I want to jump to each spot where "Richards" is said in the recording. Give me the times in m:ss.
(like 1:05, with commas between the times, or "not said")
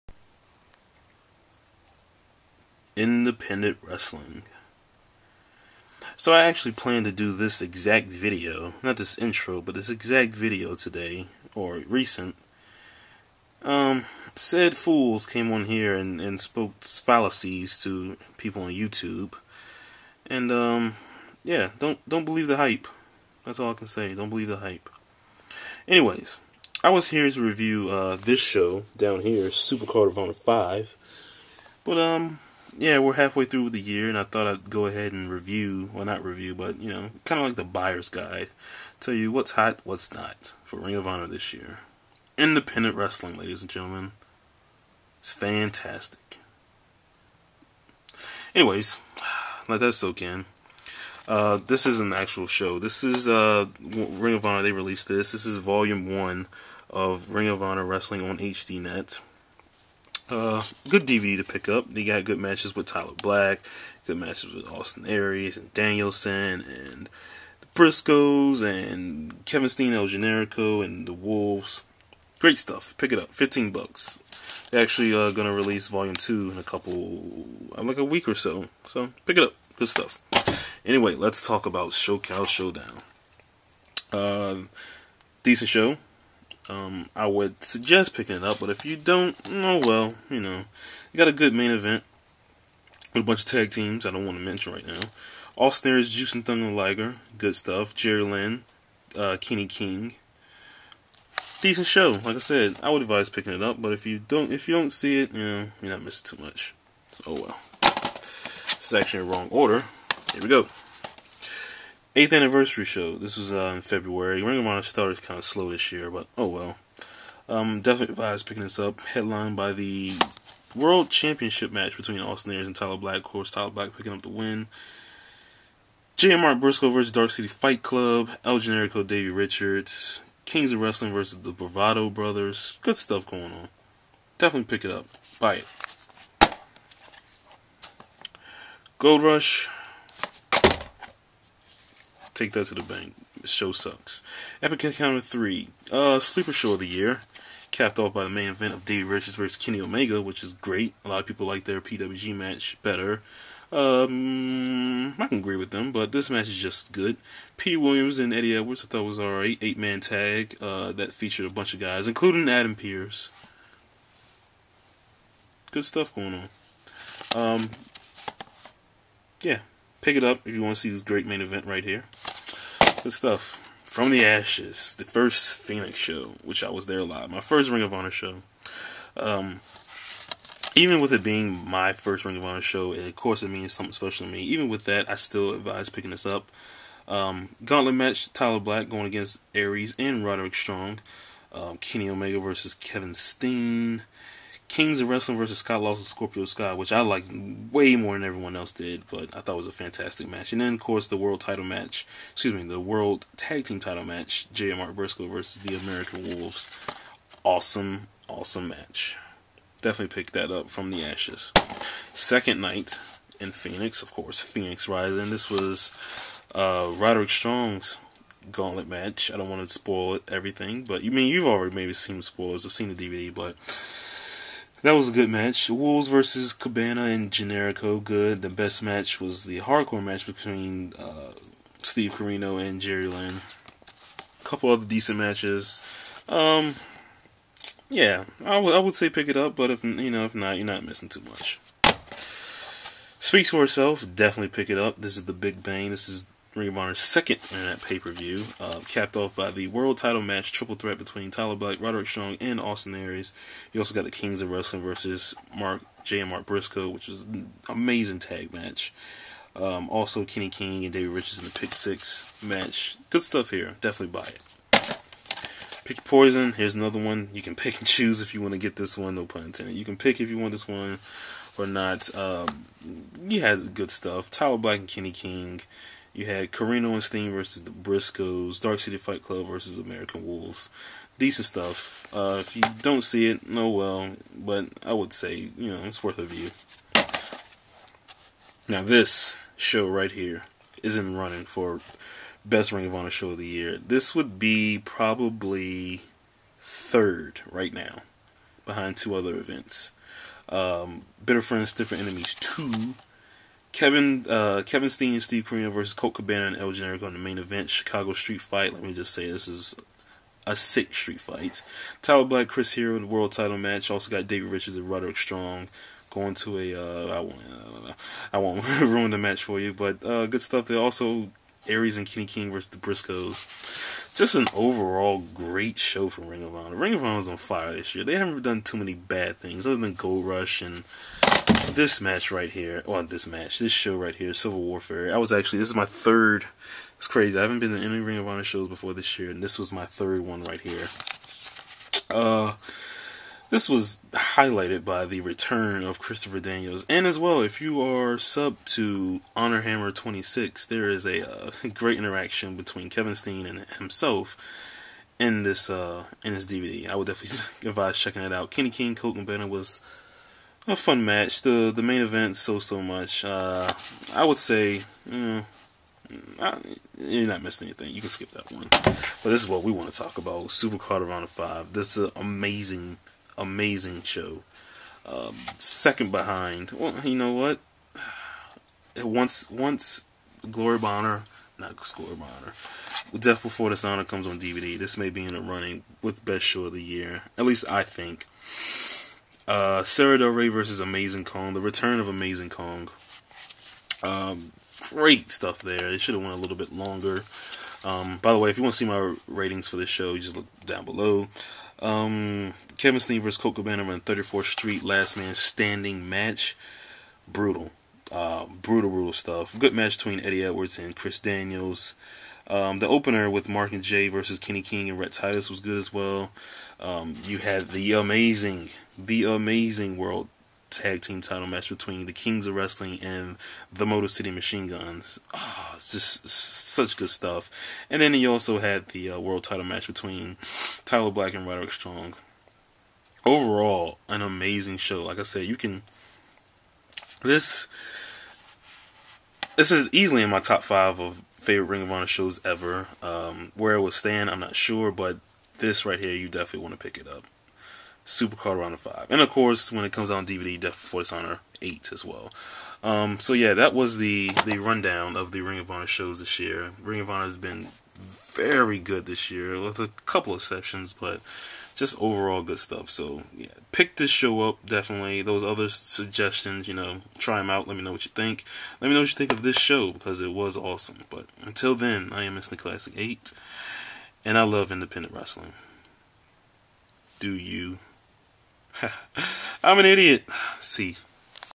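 2:09, 2:29, 4:21, 5:14.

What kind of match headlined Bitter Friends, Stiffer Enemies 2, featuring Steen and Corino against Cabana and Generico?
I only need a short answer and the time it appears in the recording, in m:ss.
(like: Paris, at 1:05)
Chicago Street Fight, at 5:07.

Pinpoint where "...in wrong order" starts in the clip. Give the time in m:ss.
1:49.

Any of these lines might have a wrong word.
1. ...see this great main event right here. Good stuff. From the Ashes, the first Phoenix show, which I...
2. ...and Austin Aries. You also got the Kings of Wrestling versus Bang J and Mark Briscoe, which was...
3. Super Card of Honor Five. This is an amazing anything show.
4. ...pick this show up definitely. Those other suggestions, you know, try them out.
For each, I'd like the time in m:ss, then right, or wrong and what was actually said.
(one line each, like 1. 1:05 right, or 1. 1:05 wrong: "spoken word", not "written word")
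1. 2:50 right
2. 4:12 wrong: "Mark", not "Bang"
3. 6:10 wrong: "amazing", not "anything"
4. 7:43 right.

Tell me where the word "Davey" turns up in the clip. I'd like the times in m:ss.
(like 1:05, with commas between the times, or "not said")
2:09, 2:28.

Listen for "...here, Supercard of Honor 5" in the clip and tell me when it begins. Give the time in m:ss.
0:29.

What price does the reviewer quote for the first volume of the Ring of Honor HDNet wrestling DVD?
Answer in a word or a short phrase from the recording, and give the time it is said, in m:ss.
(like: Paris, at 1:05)
$15, at 1:13.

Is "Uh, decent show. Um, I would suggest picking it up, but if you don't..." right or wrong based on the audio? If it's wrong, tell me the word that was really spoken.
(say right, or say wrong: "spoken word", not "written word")
right.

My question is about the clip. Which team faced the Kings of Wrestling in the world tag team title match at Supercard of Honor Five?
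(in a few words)
Motor City Machine Guns.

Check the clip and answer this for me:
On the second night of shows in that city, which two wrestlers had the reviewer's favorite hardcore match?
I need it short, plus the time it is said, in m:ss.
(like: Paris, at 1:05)
Steve Corino and Jerry Lynn, at 3:51.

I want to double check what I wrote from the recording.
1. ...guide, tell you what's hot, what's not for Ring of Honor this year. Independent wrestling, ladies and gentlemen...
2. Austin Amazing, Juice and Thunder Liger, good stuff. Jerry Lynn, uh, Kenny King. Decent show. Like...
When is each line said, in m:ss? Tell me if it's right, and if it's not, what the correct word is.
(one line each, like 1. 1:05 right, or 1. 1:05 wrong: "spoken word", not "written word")
1. 0:38 right
2. 1:35 wrong: "Aries", not "Amazing".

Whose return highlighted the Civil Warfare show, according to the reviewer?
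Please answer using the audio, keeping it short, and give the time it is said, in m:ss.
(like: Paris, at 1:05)
Christopher Daniels, at 5:45.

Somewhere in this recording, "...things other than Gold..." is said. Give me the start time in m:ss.
5:29.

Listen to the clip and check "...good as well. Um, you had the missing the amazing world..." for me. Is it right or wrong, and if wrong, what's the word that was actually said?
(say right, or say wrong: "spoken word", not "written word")
wrong: "amazing", not "missing".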